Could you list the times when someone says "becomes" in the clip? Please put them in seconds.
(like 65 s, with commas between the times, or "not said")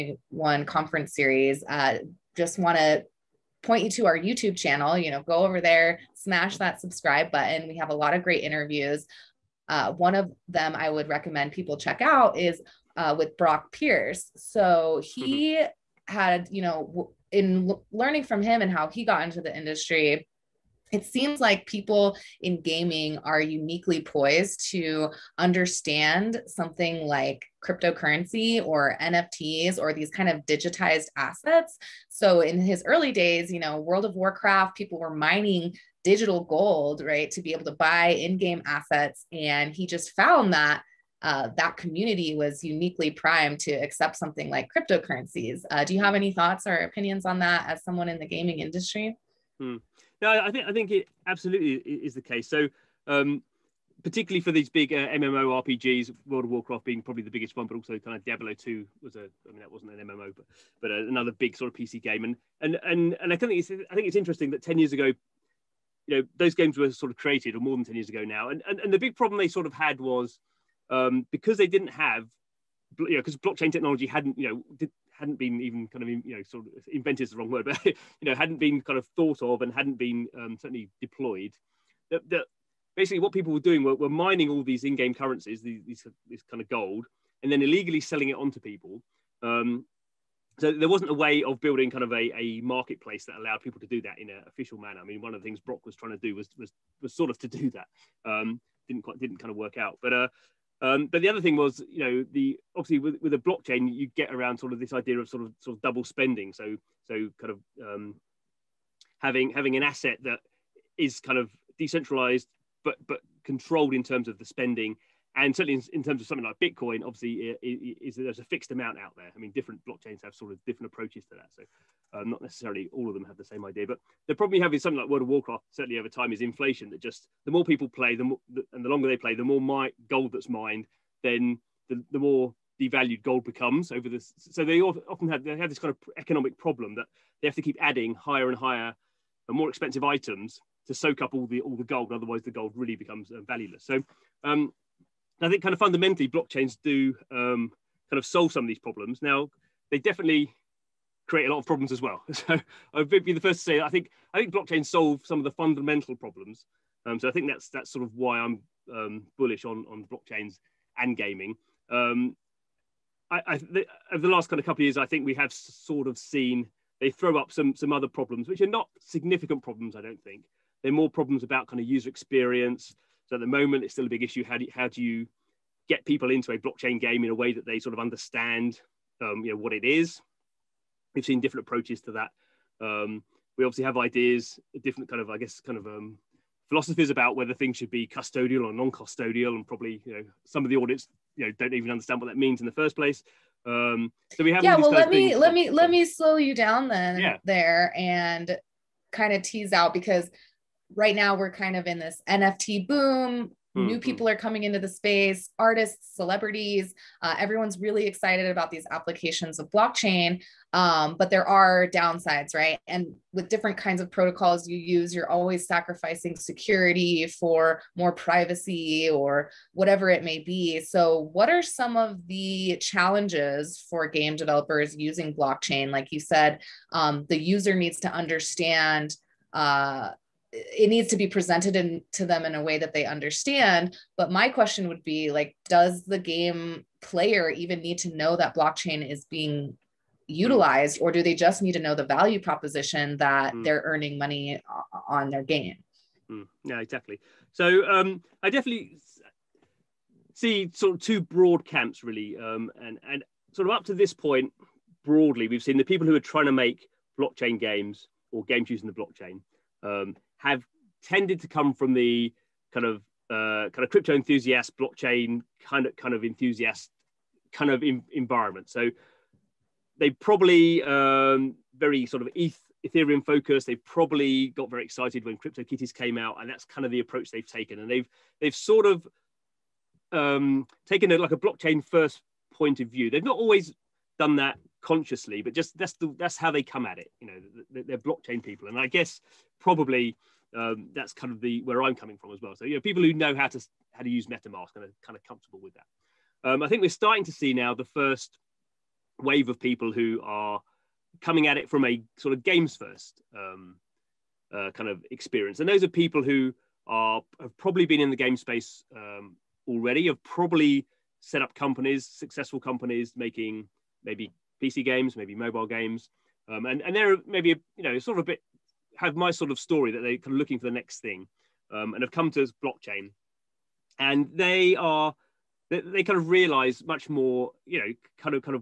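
133 s, 142 s.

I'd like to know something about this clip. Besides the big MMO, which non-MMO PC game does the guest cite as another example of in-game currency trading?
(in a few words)
Diablo Two.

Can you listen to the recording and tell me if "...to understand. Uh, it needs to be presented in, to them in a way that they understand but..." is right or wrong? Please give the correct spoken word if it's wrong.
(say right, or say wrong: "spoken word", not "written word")
right.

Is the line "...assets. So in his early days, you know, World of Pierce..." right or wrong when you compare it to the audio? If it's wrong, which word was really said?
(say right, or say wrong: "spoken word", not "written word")
wrong: "Warcraft", not "Pierce".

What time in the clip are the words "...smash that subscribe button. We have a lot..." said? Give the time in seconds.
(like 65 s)
6 s.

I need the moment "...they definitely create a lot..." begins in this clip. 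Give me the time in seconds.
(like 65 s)
149 s.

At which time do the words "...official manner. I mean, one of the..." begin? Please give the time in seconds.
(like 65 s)
94 s.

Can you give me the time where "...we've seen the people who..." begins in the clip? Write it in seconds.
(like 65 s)
255 s.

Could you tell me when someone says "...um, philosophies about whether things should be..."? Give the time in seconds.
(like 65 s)
185 s.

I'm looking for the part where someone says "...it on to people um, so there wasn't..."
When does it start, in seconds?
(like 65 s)
88 s.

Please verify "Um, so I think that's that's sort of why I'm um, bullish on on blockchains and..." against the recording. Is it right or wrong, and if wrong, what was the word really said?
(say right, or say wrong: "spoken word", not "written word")
right.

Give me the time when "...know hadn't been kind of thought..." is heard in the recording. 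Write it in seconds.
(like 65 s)
78 s.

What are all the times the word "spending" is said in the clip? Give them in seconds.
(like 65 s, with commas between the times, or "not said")
106 s, 114 s.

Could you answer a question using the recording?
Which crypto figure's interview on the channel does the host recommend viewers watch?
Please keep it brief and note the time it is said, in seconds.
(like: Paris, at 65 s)
Brock Pierce, at 13 s.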